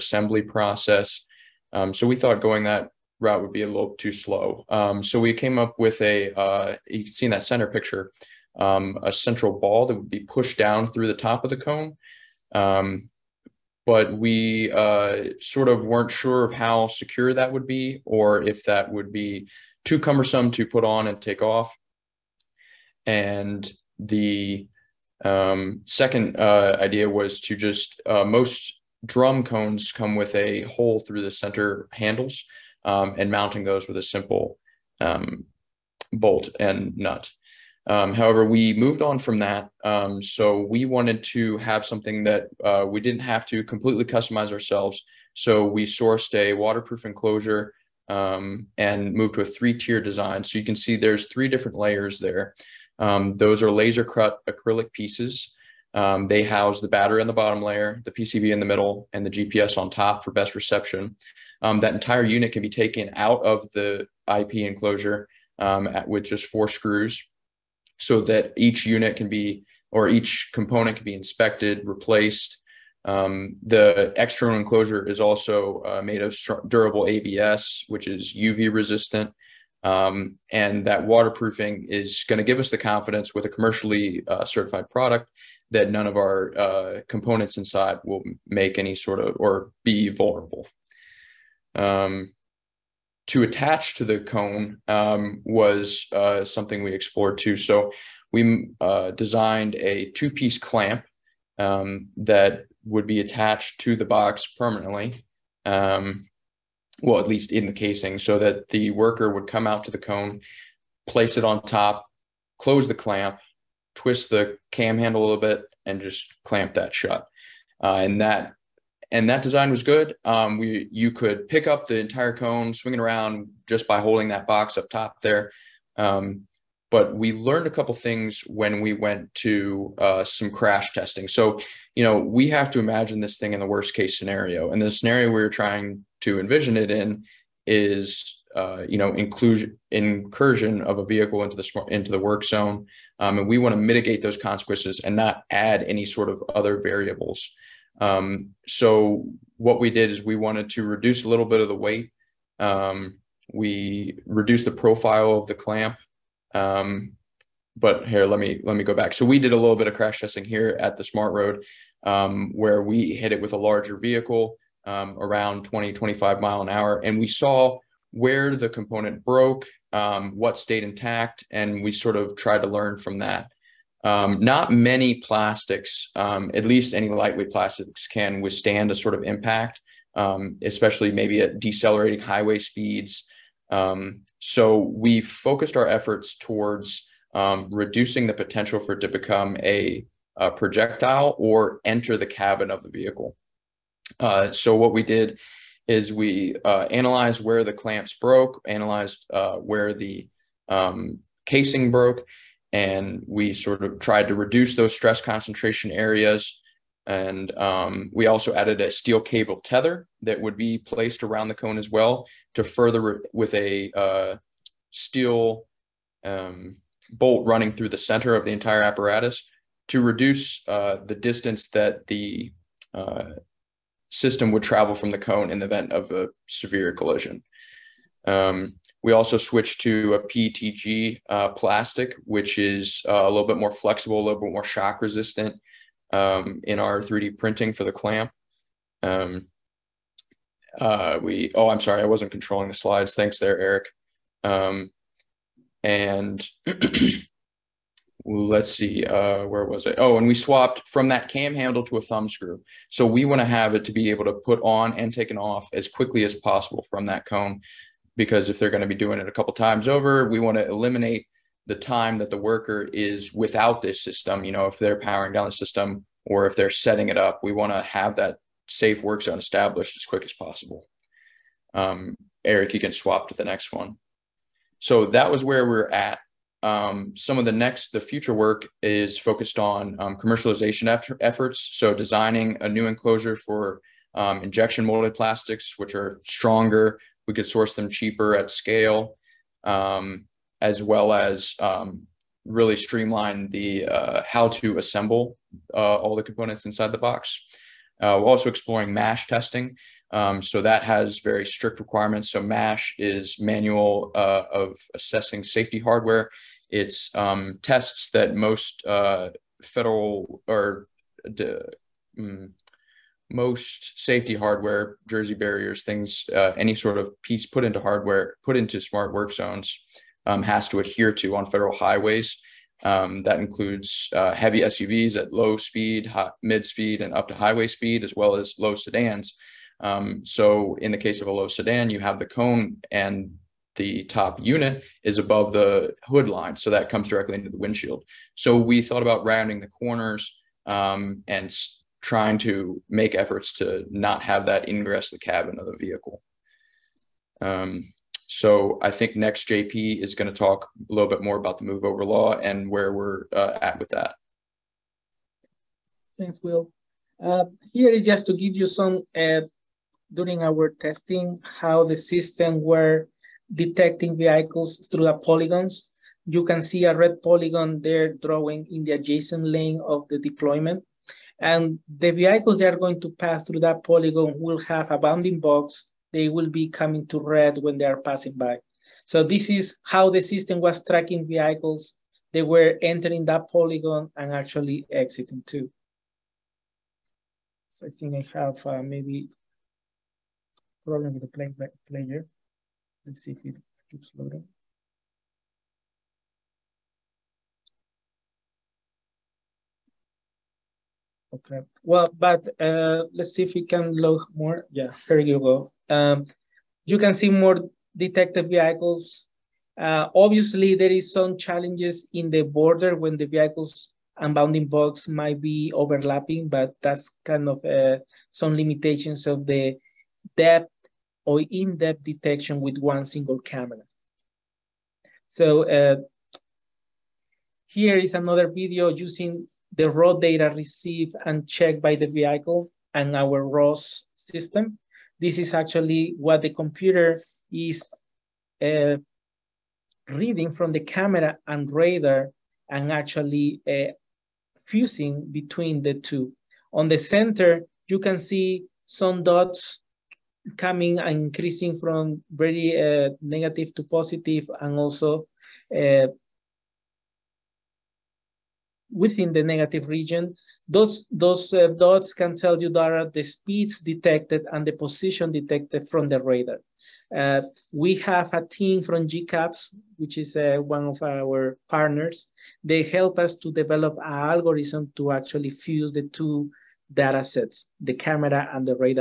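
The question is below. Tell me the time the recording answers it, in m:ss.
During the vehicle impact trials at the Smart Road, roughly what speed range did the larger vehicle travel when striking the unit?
2:45.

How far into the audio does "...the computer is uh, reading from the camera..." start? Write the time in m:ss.
7:16.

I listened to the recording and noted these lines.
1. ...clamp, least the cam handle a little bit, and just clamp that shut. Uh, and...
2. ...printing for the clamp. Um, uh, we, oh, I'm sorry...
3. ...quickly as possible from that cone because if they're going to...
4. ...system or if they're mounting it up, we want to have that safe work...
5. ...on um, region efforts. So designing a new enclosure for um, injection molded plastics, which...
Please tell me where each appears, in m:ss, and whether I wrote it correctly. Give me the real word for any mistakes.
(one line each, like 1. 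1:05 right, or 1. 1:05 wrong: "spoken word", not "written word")
1. 1:52 wrong: "twist", not "least"
2. 3:57 right
3. 4:15 right
4. 4:25 wrong: "setting", not "mounting"
5. 4:39 wrong: "commercialization", not "region".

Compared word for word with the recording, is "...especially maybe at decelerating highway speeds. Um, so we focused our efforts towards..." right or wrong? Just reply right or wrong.
right.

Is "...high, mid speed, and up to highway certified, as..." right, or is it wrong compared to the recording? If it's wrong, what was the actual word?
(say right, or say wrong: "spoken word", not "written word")
wrong: "speed", not "certified".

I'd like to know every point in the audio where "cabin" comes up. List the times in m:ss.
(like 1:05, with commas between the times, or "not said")
3:12, 5:45.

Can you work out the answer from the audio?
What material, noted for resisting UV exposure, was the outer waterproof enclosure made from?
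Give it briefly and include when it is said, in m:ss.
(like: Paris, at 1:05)
ABS, at 1:16.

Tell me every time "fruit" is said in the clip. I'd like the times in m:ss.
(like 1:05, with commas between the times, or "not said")
not said.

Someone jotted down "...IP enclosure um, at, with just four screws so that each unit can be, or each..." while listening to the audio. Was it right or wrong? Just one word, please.
right.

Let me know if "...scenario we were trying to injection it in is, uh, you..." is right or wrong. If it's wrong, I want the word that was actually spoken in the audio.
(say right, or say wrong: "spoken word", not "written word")
wrong: "envision", not "injection".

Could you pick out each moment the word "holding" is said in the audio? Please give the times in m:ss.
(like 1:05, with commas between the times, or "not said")
2:03.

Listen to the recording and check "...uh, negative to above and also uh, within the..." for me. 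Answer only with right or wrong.
wrong.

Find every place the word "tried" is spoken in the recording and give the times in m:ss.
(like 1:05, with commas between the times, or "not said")
2:52, 3:23.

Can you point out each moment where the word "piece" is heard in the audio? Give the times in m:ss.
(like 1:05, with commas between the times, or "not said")
0:54, 1:40, 5:17.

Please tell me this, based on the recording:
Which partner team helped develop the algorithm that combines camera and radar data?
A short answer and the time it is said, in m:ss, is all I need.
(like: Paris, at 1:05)
GCAPS, at 7:49.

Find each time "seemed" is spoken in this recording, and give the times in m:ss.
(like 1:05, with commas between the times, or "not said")
not said.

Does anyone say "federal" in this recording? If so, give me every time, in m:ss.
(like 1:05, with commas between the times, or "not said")
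5:09, 5:21.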